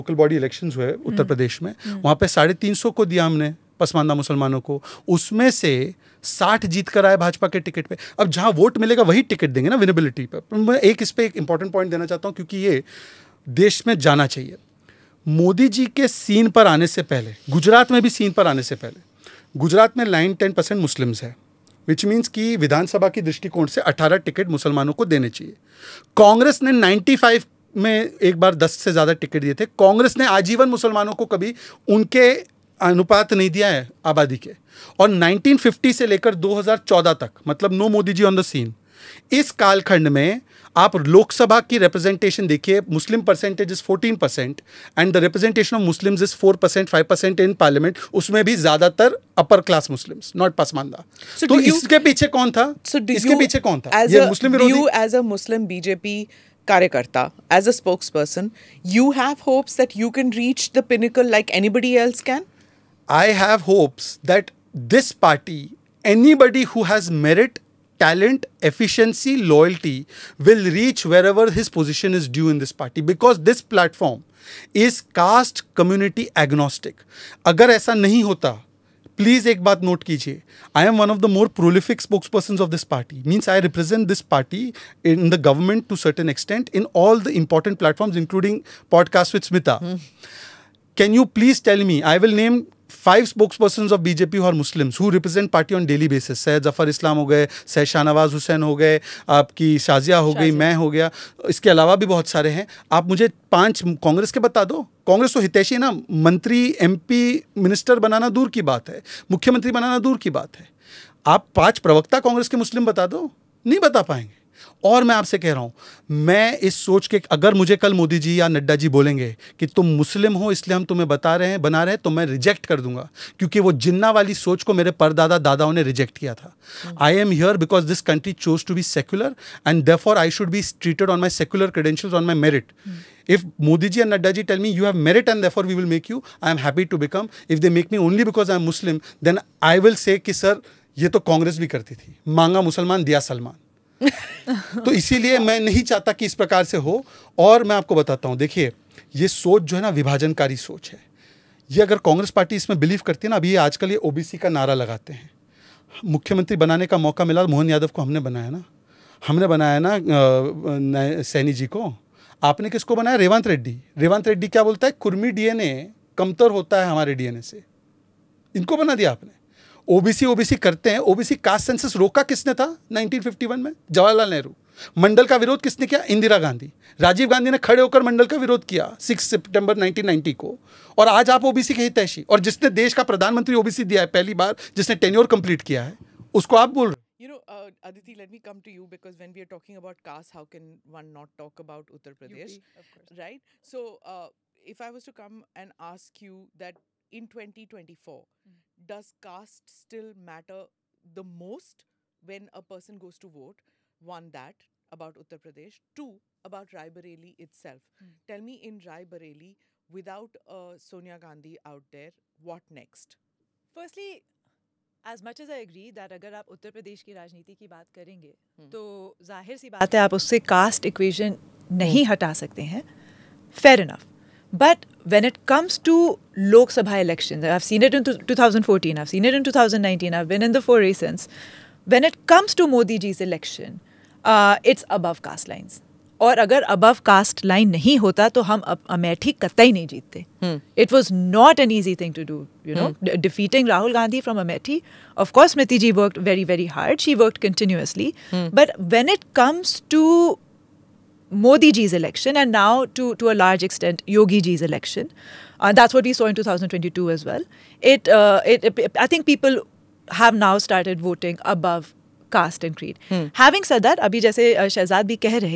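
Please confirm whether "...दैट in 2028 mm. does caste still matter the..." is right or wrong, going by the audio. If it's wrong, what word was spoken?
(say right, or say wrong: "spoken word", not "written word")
wrong: "2024", not "2028".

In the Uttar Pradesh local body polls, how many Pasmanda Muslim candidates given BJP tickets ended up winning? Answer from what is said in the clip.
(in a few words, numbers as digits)
60.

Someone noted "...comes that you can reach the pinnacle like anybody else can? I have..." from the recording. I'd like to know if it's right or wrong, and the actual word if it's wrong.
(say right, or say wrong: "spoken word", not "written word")
wrong: "hopes", not "comes".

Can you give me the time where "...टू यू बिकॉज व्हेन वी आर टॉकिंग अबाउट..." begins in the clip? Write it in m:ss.
3:08.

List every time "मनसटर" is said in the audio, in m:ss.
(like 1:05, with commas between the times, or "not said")
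1:47.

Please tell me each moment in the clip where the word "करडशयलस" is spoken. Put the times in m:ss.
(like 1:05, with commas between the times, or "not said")
2:11.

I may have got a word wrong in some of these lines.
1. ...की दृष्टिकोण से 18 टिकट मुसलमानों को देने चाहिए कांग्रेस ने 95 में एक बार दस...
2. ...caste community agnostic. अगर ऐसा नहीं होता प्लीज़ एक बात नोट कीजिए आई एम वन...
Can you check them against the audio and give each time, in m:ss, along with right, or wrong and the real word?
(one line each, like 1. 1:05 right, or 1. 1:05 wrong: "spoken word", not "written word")
1. 0:23 right
2. 1:15 right.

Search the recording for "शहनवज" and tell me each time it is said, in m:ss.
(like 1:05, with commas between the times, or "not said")
1:37.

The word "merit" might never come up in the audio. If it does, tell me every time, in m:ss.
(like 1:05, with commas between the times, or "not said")
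1:07, 2:15.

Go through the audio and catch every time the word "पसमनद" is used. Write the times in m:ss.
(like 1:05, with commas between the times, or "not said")
0:03, 0:50.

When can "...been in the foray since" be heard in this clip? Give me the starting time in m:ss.
3:50.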